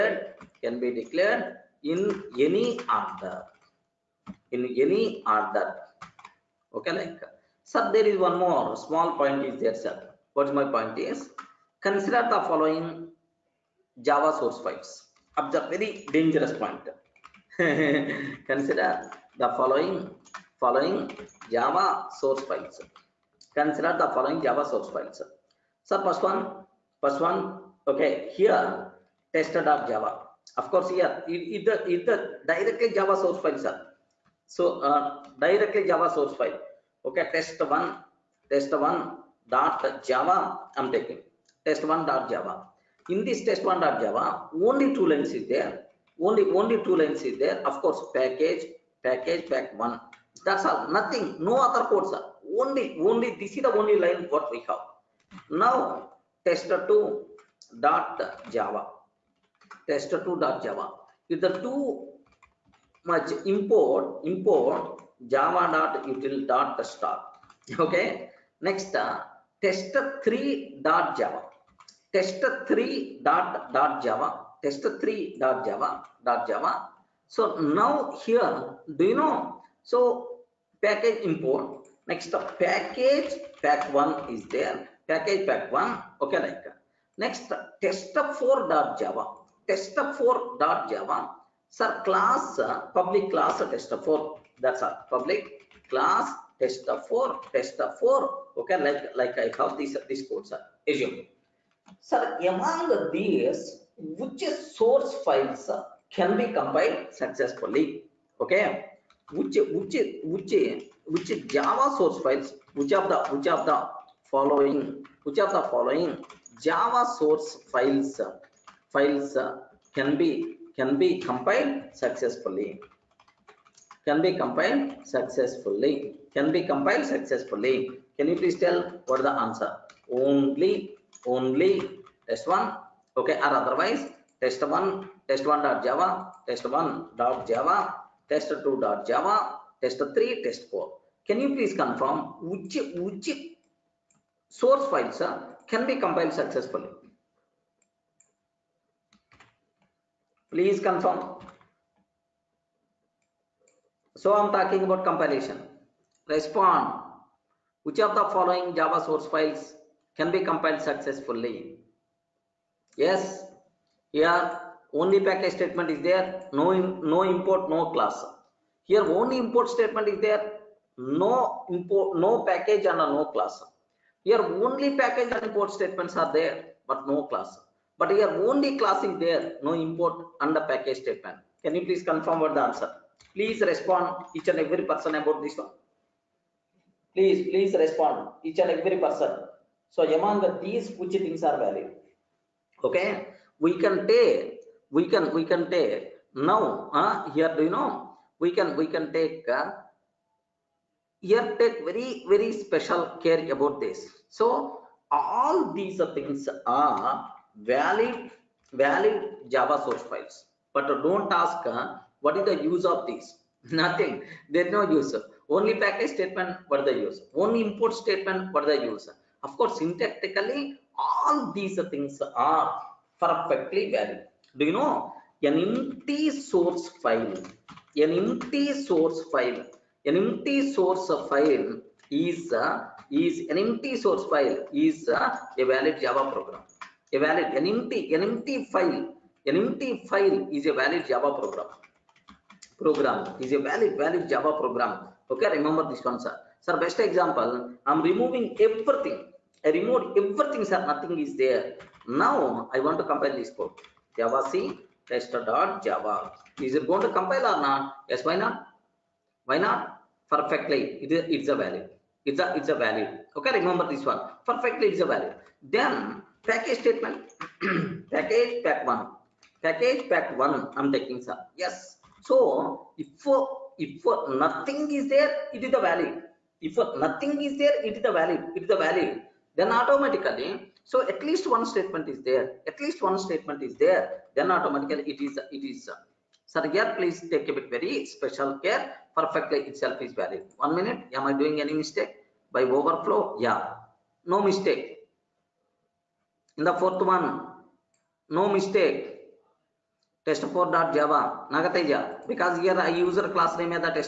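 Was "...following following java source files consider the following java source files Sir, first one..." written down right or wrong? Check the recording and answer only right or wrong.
right.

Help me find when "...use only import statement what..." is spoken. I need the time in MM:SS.
03:37.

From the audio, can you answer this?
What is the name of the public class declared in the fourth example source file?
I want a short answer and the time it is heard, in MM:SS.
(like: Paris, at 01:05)
Test4, at 01:35.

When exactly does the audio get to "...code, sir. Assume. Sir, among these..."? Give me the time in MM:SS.
01:40.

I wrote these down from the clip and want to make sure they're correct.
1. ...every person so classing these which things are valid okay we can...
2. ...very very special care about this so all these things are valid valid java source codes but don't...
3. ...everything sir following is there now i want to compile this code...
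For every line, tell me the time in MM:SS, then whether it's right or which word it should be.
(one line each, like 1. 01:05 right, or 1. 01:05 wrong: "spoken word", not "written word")
1. 03:08 wrong: "among", not "classing"
2. 03:21 wrong: "files", not "codes"
3. 04:10 wrong: "nothing", not "following".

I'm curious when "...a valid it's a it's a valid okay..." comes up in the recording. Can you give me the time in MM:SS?
04:21.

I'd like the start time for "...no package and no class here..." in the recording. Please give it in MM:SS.
02:52.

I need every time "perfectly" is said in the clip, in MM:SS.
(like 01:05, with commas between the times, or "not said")
03:43, 04:20, 04:24, 04:49.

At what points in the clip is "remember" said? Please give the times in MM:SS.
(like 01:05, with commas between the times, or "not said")
04:05, 04:23.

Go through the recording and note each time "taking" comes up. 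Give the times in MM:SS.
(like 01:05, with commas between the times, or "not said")
00:40, 04:30.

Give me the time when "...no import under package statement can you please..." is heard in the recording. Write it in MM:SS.
02:59.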